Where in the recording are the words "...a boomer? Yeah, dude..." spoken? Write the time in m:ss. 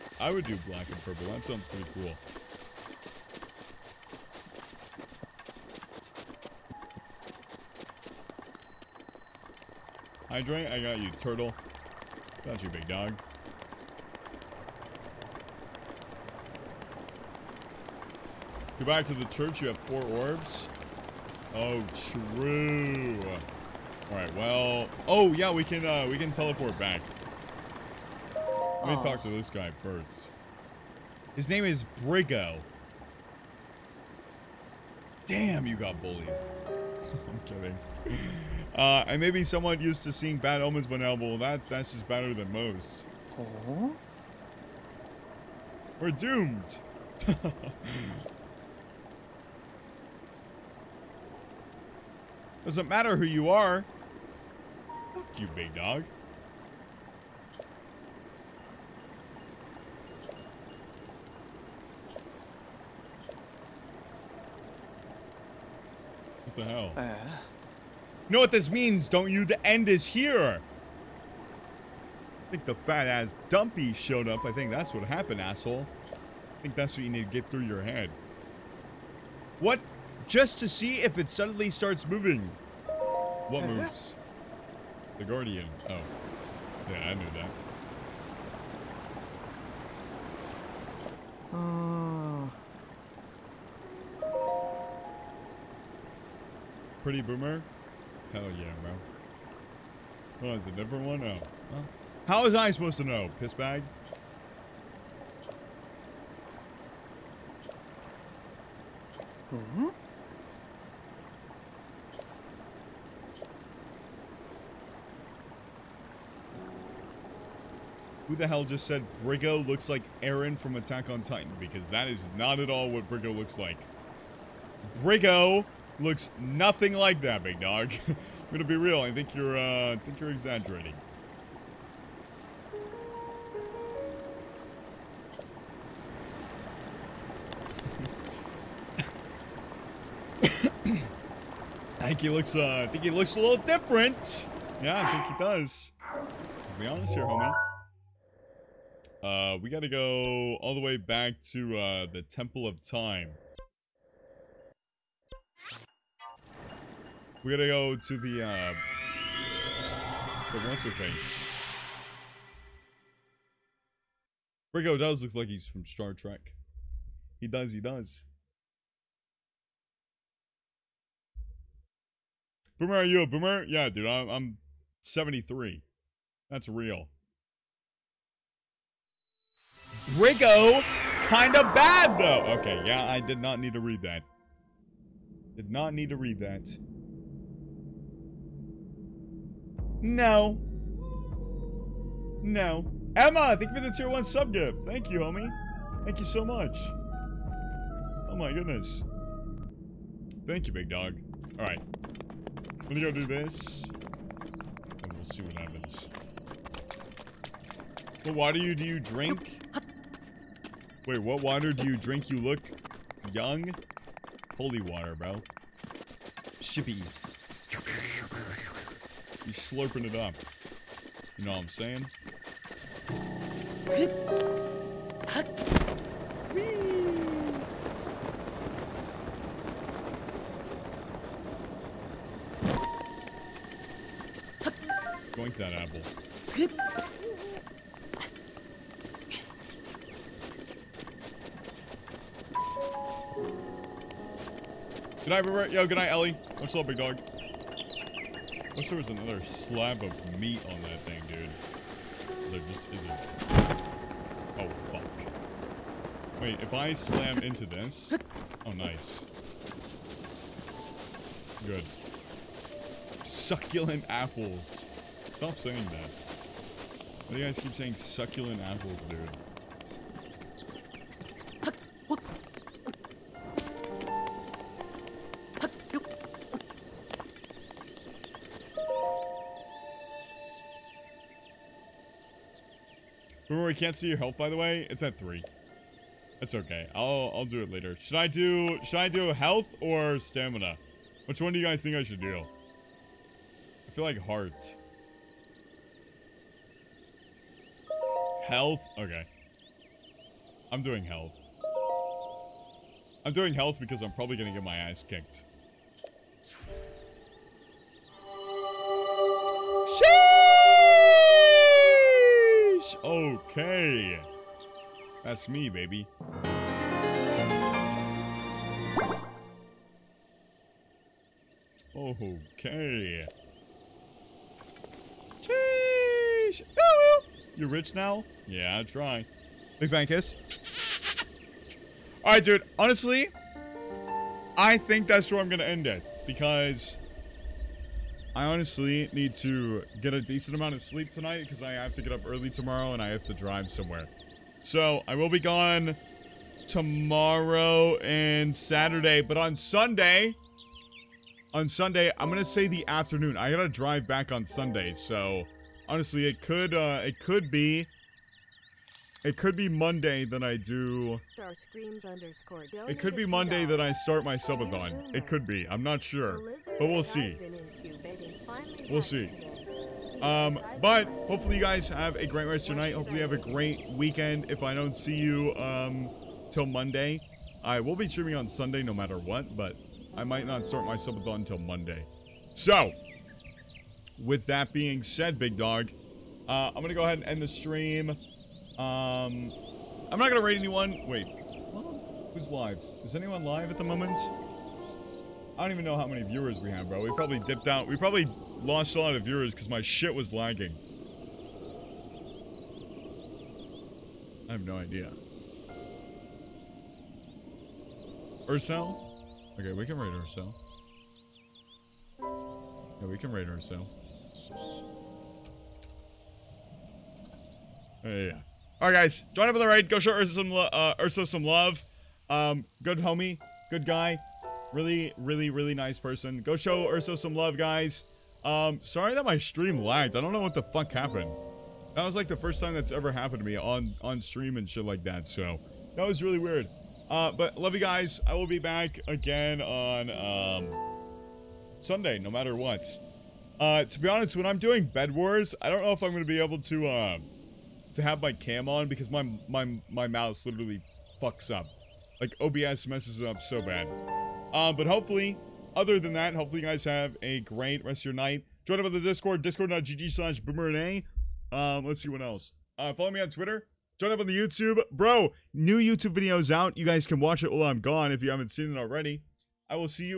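2:53.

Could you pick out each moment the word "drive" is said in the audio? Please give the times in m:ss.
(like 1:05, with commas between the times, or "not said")
5:43, 5:53.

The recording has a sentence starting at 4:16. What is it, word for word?
Wait, if I slam into this...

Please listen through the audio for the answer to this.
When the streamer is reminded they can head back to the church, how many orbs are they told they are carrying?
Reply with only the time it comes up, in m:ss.
0:19.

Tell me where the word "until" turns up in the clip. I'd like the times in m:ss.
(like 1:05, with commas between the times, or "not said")
6:21.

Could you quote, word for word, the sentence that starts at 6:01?
Star screams underscore it could be Monday that I start my subathon.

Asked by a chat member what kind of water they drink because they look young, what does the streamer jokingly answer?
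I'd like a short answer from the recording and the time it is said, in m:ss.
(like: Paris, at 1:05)
Holy water, at 3:34.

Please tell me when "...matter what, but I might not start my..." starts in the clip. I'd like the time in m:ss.
6:18.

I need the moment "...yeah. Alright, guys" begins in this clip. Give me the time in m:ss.
6:58.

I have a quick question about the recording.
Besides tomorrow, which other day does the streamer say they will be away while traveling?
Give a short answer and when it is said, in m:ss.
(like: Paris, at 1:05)
Saturday, at 5:48.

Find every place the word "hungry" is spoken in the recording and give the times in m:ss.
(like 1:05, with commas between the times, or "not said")
not said.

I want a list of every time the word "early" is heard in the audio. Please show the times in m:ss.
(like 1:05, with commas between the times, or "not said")
5:42.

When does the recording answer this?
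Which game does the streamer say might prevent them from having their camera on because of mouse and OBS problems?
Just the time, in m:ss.
7:24.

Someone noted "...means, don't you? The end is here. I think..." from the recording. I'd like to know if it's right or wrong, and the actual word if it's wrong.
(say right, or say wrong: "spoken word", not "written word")
right.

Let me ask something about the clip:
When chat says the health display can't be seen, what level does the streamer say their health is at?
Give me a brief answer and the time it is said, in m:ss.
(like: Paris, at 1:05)
3, at 4:45.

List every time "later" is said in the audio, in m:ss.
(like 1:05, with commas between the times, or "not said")
4:47.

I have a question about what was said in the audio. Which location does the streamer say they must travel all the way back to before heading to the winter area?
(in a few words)
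Temple of Time.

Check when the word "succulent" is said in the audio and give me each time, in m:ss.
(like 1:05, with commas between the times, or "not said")
4:23, 4:27.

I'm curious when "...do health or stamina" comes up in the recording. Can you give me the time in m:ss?
4:49.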